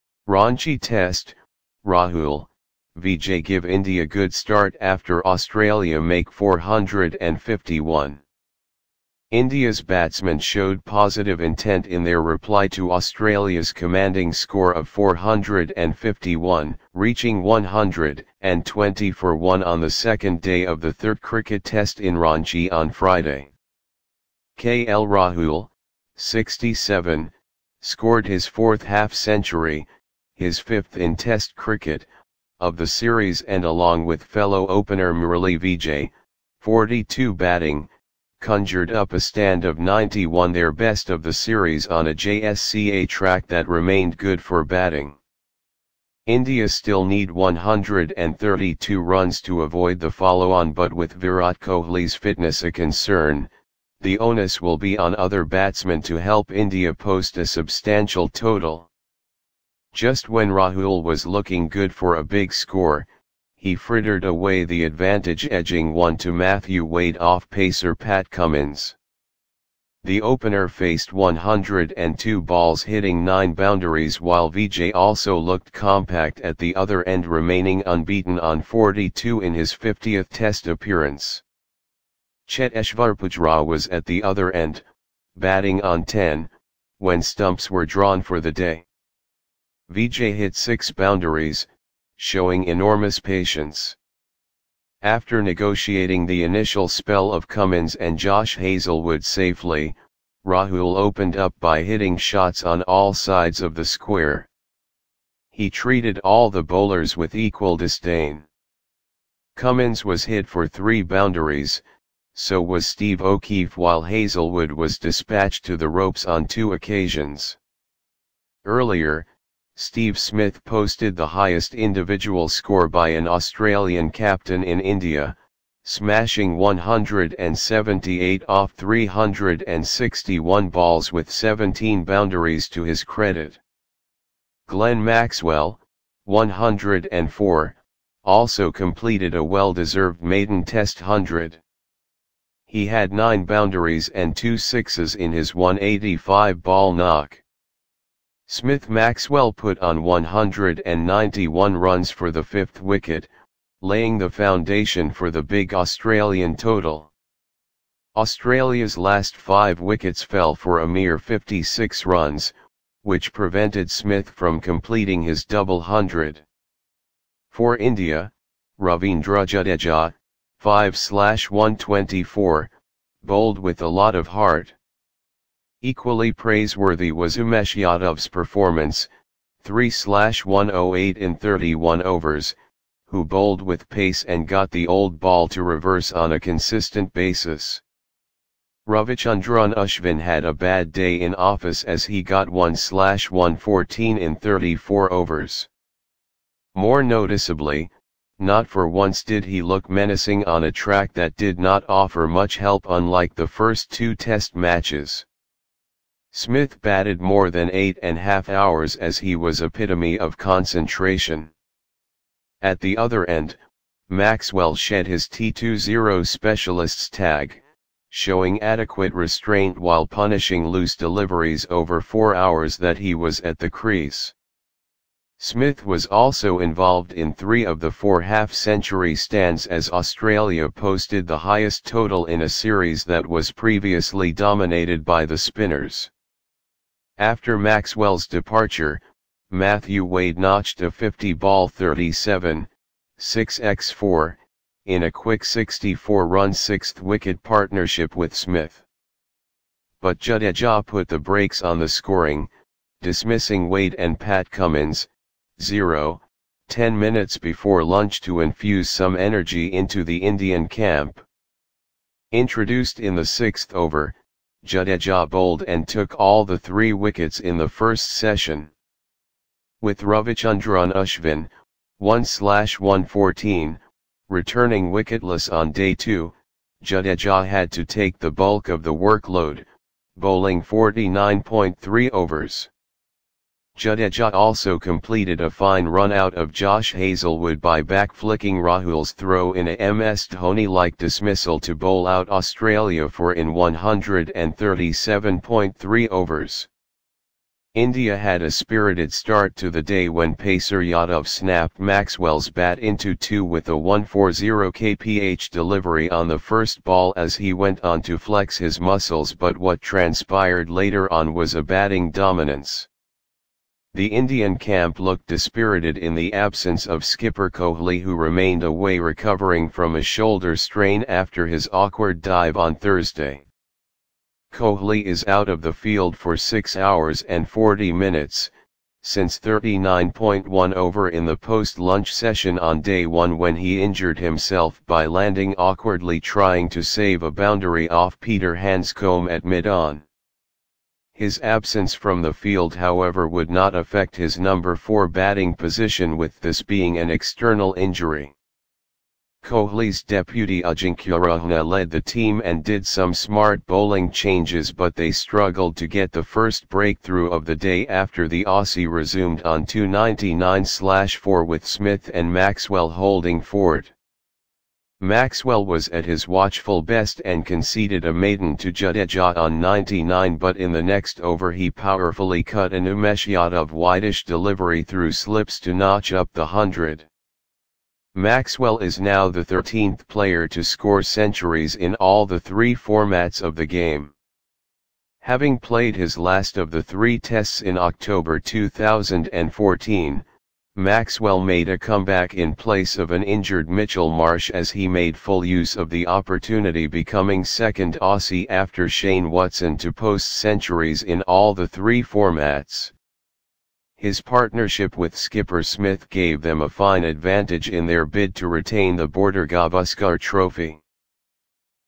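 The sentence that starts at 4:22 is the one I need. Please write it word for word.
Introduced in the sixth over, Jadeja bowled and took all the three wickets in the first session.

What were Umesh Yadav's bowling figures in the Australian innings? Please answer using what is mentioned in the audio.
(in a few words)
3-108.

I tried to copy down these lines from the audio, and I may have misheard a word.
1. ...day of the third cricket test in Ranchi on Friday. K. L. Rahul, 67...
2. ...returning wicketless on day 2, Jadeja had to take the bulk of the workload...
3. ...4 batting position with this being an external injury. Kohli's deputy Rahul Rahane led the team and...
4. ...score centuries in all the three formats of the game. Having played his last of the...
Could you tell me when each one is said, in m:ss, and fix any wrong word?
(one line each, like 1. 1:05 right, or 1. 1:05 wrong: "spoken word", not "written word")
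1. 0:20 right
2. 4:34 right
3. 5:44 wrong: "Ajinkya", not "Rahul"
4. 6:20 right.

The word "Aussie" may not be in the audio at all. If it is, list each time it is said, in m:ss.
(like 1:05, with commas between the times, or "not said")
5:58, 6:38.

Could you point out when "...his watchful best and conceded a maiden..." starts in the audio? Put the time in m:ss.
6:06.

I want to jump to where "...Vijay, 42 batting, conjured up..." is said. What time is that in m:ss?
0:35.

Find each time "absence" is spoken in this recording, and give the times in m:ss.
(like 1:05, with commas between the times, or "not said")
5:16, 5:41.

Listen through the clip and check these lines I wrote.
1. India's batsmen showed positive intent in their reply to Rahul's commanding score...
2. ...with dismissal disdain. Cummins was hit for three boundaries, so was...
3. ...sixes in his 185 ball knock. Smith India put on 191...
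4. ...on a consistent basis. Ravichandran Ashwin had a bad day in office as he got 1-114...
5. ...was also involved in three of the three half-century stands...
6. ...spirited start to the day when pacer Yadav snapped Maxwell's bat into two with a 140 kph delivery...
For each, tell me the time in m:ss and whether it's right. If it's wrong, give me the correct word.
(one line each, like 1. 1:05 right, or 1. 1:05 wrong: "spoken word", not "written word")
1. 0:09 wrong: "Australia", not "Rahul"
2. 1:47 wrong: "equal", not "dismissal"
3. 2:24 wrong: "Maxwell", not "India"
4. 3:06 right
5. 3:45 wrong: "four", not "three"
6. 4:58 right.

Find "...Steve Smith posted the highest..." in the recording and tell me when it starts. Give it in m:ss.
1:59.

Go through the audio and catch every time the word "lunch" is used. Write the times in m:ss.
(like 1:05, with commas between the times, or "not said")
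4:17, 5:31.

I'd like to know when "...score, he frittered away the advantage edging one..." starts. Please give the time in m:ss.
1:02.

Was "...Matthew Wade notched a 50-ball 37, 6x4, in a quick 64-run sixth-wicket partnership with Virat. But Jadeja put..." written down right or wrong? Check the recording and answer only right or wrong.
wrong.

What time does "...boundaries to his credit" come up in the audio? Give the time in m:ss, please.
2:12.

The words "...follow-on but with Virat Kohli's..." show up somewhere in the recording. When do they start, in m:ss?
0:50.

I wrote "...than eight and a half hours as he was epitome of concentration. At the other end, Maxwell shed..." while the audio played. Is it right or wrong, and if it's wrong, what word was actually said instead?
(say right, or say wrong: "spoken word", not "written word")
right.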